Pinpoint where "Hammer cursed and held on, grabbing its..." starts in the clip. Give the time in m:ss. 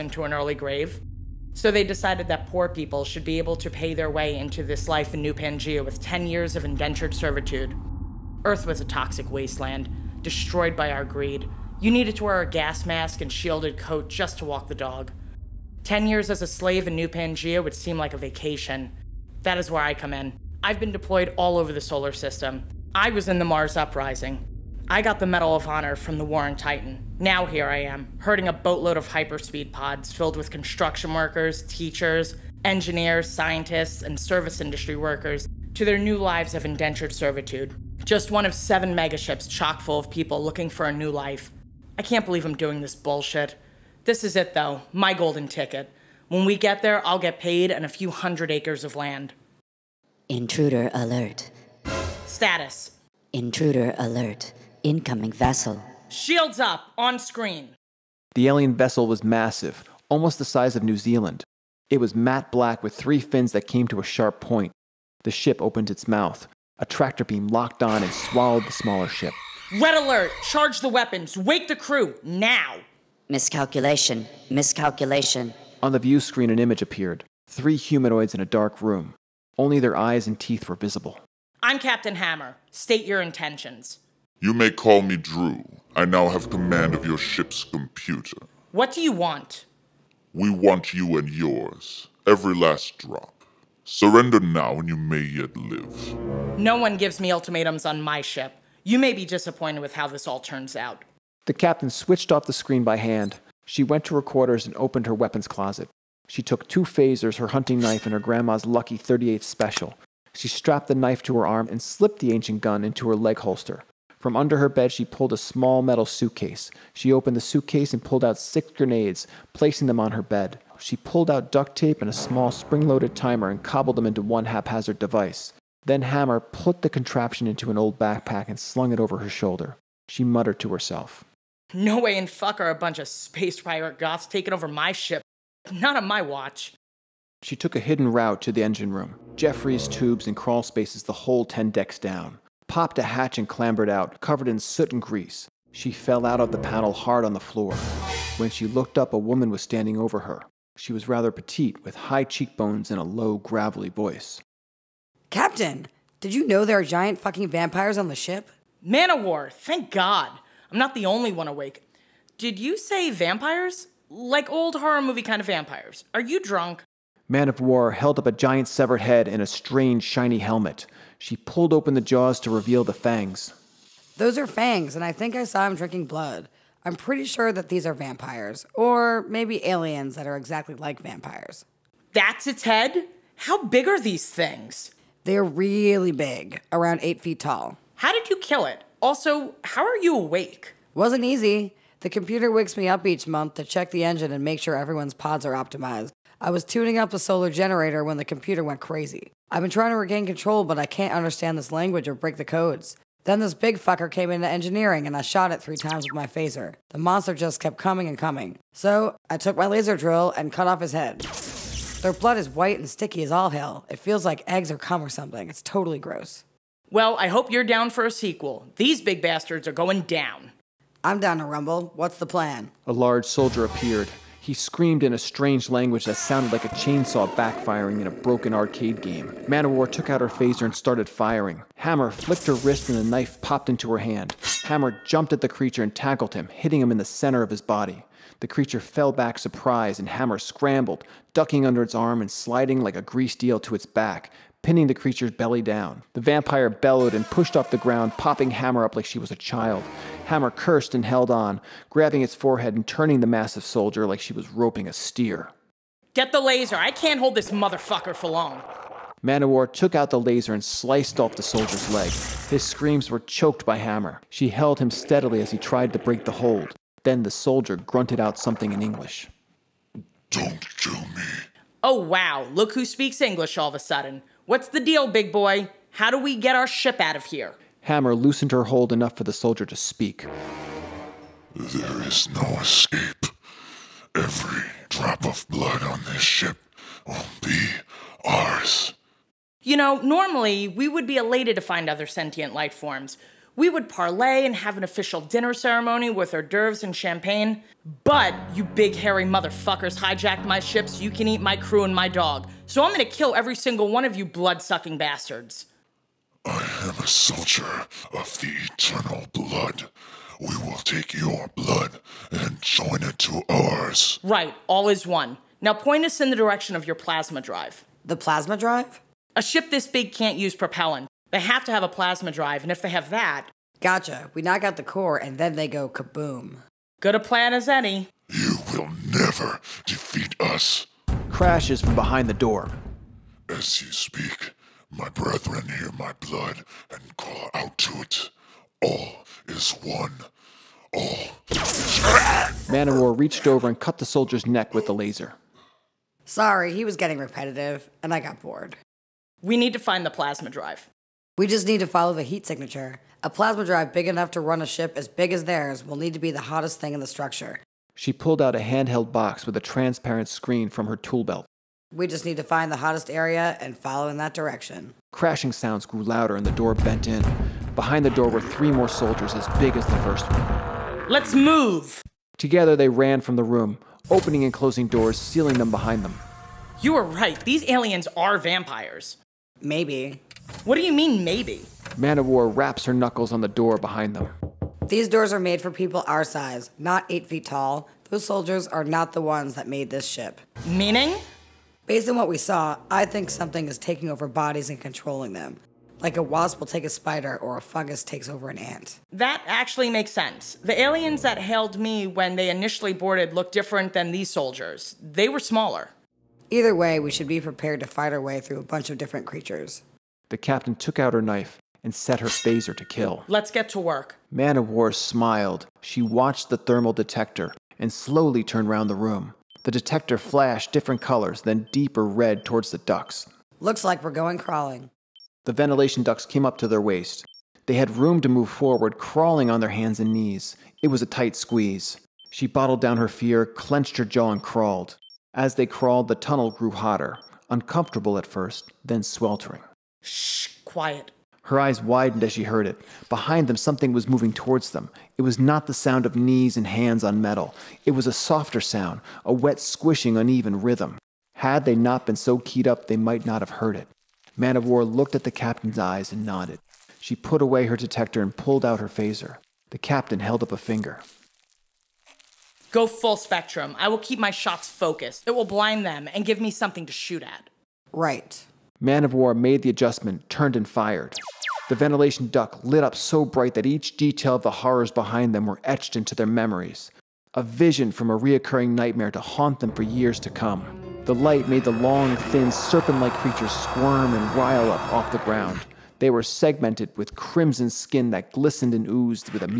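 4:10.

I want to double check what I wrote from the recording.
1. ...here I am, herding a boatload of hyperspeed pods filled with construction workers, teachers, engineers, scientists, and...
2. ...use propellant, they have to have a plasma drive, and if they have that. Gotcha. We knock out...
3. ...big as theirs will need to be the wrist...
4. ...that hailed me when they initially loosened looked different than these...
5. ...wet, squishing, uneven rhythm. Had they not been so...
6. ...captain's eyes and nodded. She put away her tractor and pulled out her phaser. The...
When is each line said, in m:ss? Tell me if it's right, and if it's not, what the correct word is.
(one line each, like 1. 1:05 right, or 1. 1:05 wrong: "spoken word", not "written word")
1. 0:27 right
2. 5:20 right
3. 5:55 wrong: "hottest", not "wrist"
4. 6:41 wrong: "boarded", not "loosened"
5. 7:29 right
6. 7:35 wrong: "detector", not "tractor".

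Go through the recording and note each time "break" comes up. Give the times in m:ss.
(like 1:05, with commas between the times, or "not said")
3:22, 4:25.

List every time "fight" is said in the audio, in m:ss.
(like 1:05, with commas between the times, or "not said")
6:47.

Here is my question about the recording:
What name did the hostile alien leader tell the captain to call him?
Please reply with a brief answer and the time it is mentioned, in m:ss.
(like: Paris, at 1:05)
Drew, at 1:25.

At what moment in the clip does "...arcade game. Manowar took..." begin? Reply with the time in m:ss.
3:48.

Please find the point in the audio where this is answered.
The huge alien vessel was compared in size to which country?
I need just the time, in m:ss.
1:00.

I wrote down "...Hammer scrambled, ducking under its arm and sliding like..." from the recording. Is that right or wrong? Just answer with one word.
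right.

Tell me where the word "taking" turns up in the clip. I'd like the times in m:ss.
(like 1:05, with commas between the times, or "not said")
2:14, 6:33.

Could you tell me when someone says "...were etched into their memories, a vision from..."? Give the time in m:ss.
7:55.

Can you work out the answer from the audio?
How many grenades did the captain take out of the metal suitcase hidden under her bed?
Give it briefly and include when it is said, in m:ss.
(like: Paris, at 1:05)
6, at 1:58.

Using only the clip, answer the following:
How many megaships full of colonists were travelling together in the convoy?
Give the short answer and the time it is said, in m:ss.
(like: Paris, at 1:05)
7, at 0:38.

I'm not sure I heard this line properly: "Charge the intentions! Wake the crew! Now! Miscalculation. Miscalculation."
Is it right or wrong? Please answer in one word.
wrong.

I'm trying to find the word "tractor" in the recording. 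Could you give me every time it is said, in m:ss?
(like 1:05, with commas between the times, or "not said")
1:06.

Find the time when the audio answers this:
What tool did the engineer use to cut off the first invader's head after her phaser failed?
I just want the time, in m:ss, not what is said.
3:29.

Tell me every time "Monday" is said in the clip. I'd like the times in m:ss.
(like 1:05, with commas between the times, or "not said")
not said.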